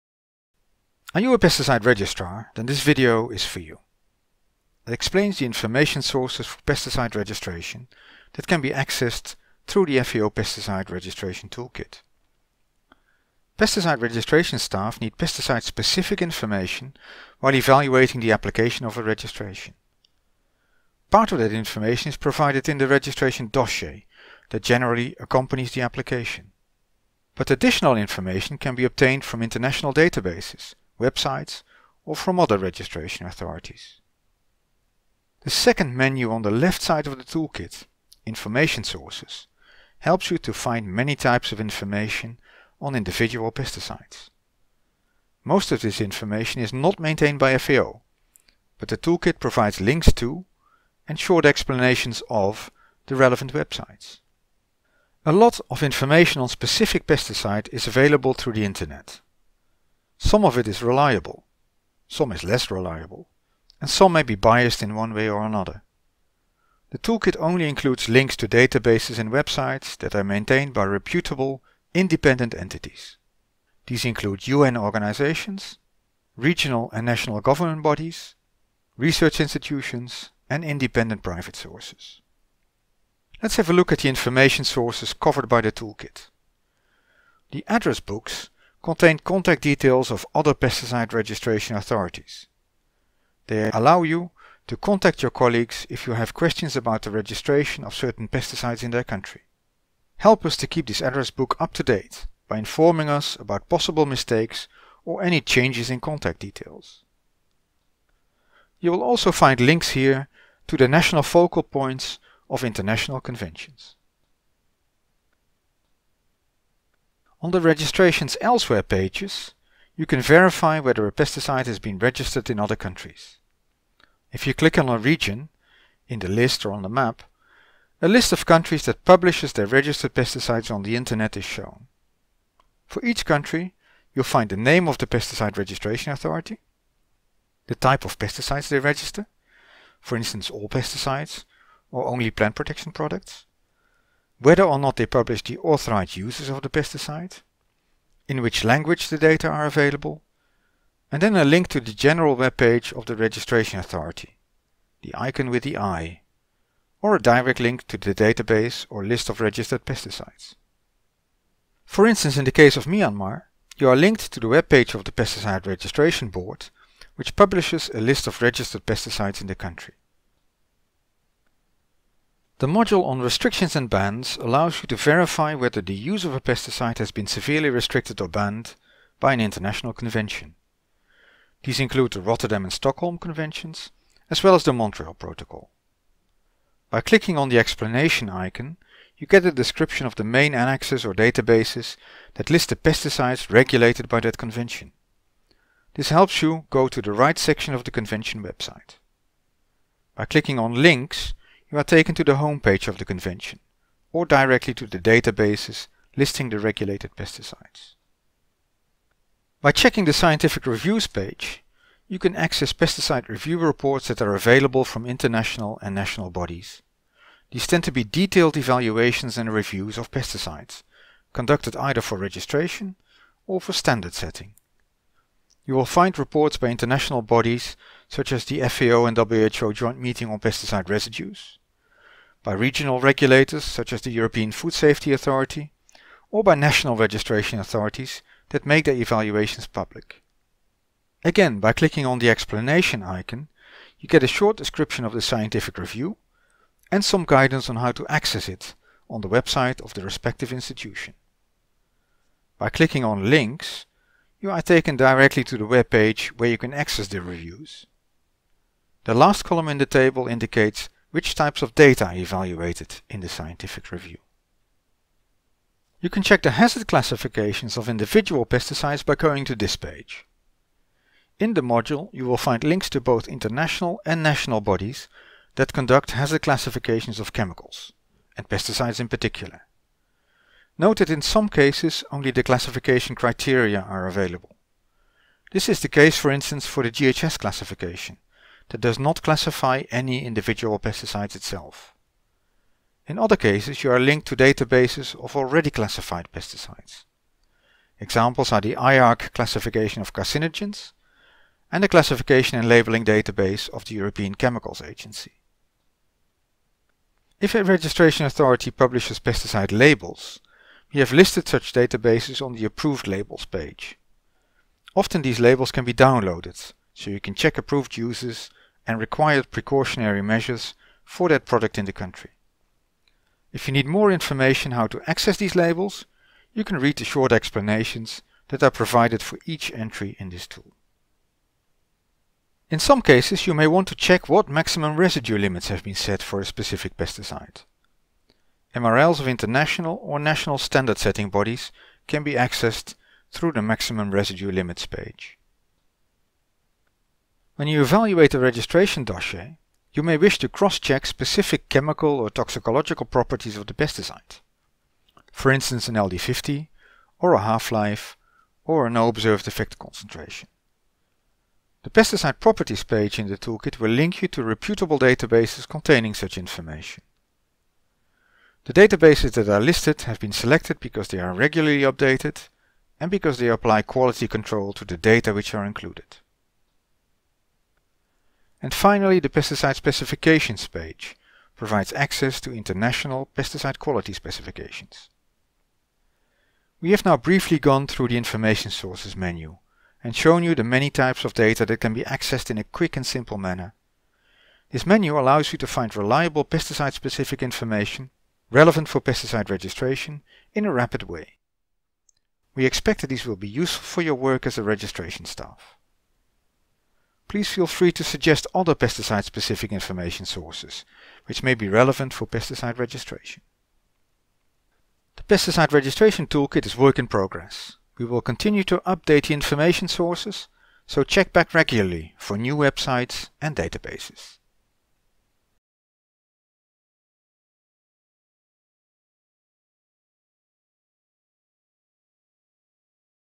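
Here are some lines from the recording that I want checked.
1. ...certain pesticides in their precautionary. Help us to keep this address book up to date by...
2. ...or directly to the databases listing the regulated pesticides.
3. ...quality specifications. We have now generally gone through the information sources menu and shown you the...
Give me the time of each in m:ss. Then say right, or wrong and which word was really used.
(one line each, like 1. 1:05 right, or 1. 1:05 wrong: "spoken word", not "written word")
1. 1:37 wrong: "country", not "precautionary"
2. 3:24 right
3. 6:23 wrong: "briefly", not "generally".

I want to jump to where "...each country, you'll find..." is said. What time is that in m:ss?
2:13.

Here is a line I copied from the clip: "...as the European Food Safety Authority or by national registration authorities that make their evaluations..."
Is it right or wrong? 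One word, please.
right.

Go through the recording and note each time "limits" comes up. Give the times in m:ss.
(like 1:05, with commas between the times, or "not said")
5:35, 5:44.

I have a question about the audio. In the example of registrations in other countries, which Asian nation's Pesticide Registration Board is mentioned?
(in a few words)
Myanmar.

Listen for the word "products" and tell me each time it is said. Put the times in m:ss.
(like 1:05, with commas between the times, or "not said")
2:22, 5:21.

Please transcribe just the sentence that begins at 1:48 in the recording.
You will also find links here to the national focal points of international conventions.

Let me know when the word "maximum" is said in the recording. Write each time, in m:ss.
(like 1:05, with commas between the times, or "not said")
5:34, 5:43.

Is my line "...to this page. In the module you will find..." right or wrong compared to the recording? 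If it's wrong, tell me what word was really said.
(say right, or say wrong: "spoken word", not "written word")
right.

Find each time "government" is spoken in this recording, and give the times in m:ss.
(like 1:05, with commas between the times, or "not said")
1:17.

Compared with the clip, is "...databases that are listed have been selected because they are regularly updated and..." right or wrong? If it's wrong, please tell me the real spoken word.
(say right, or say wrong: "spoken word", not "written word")
right.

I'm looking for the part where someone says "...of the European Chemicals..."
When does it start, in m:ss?
5:03.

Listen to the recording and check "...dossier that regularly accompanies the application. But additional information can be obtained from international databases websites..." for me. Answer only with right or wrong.
wrong.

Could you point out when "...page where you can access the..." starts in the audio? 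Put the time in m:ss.
4:15.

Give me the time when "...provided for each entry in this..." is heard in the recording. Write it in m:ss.
5:28.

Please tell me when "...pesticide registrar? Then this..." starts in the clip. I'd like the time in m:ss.
0:01.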